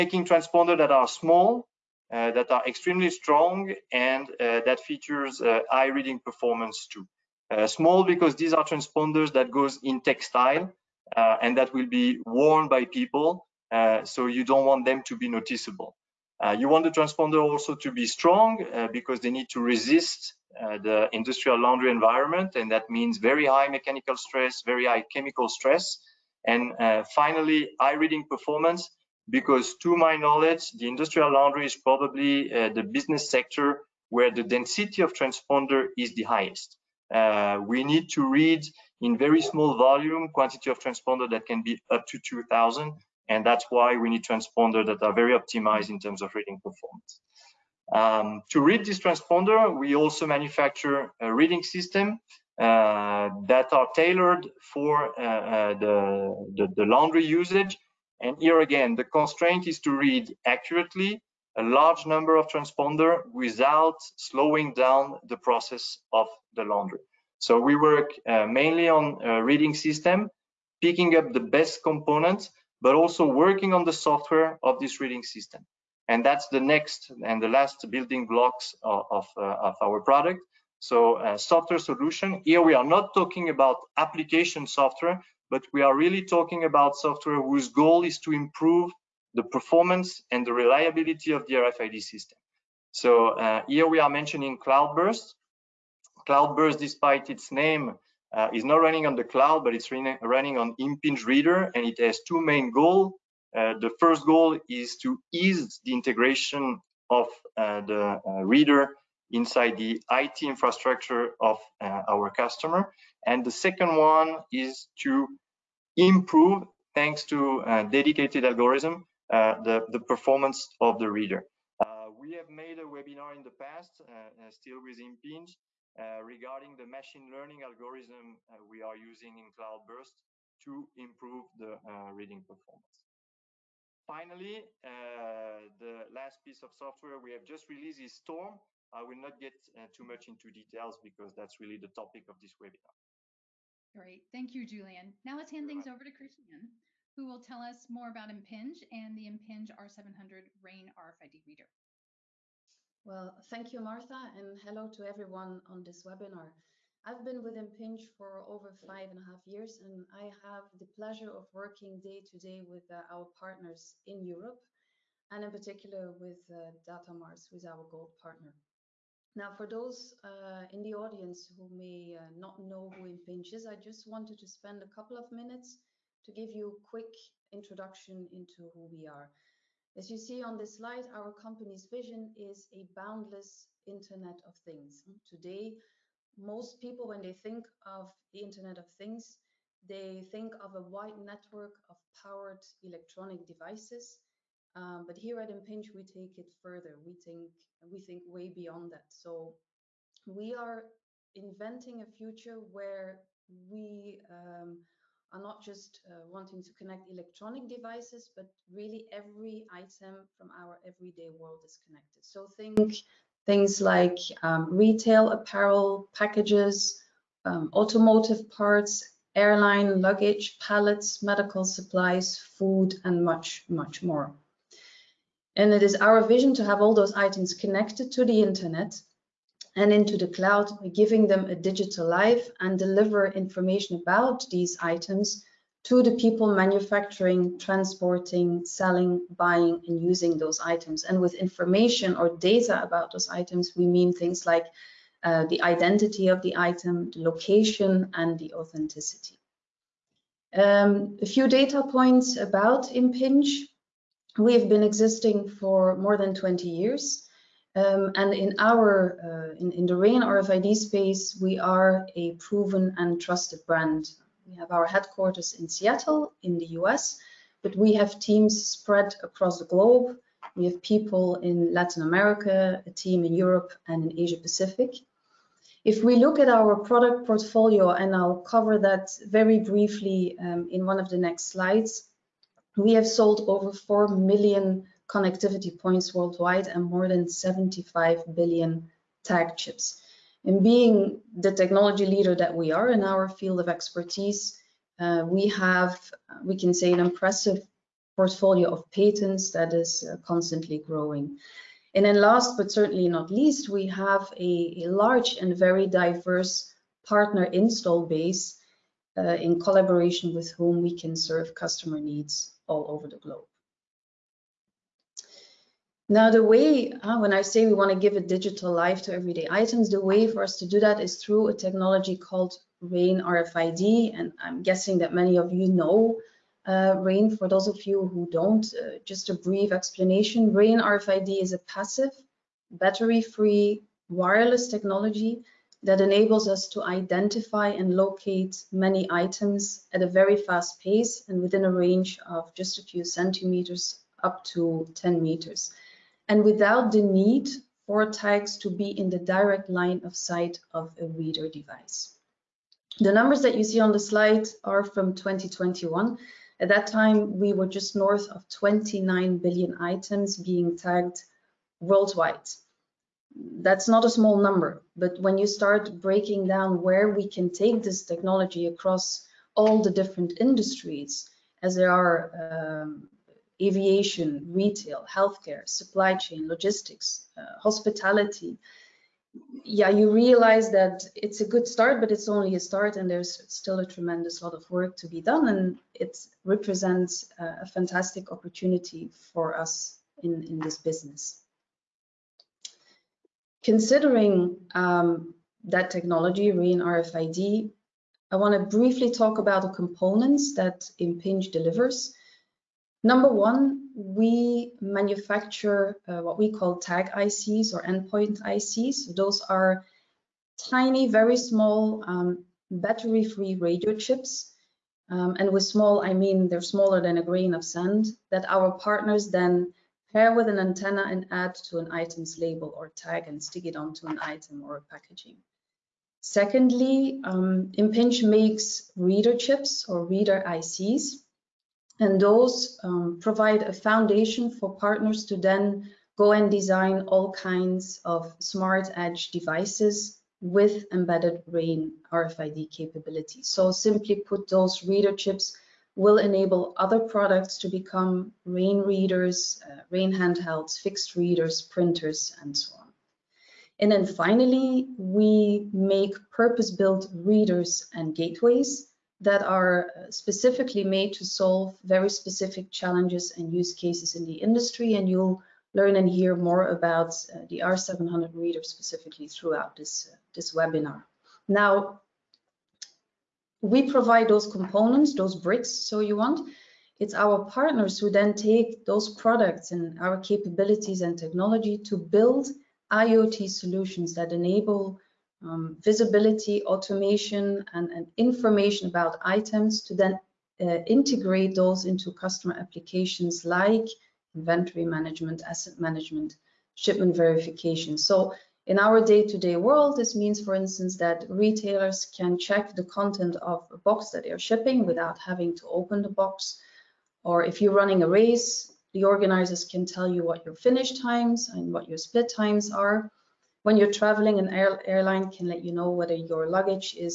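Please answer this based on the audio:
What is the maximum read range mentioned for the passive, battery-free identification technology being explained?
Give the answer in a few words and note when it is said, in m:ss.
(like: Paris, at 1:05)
10 meters, at 5:44.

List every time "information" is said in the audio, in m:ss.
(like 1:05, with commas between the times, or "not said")
3:53, 4:01, 8:08.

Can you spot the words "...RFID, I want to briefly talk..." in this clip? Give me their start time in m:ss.
6:36.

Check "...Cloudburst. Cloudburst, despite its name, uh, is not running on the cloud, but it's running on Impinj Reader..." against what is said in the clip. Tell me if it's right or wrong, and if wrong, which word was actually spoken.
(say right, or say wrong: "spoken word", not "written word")
right.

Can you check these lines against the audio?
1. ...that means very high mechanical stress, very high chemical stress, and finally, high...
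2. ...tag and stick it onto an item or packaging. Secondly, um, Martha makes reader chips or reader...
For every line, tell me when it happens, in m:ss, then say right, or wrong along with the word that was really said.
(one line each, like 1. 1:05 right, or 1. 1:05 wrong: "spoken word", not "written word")
1. 0:22 right
2. 7:02 wrong: "Impinj", not "Martha".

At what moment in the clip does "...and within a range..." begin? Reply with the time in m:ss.
5:41.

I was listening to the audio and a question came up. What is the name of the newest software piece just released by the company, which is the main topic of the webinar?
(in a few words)
Storm.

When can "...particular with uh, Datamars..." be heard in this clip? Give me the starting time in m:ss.
2:45.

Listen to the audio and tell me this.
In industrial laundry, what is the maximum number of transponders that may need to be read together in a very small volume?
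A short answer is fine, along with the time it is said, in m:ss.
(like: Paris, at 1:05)
2000, at 0:42.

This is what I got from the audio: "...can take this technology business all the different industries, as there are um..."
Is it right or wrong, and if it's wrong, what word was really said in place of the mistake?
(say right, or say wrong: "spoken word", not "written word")
wrong: "across", not "business".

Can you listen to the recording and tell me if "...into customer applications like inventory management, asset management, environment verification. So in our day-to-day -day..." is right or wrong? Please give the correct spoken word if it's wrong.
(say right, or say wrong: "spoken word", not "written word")
wrong: "shipment", not "environment".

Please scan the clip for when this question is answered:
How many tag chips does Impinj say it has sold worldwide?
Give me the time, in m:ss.
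4:47.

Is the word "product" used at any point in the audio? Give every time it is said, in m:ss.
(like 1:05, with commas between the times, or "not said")
1:20, 4:36, 7:26, 7:59.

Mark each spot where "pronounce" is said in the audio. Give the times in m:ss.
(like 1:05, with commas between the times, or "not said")
not said.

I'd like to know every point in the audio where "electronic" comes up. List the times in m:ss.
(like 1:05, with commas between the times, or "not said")
3:12, 3:27.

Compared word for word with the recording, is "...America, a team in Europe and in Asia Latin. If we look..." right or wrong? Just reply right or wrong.
wrong.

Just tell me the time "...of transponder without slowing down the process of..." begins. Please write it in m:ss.
1:02.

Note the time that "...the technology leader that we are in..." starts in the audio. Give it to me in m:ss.
4:51.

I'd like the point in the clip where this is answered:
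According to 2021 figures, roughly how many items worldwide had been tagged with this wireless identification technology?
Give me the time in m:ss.
5:58.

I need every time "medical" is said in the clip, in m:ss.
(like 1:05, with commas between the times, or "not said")
3:41.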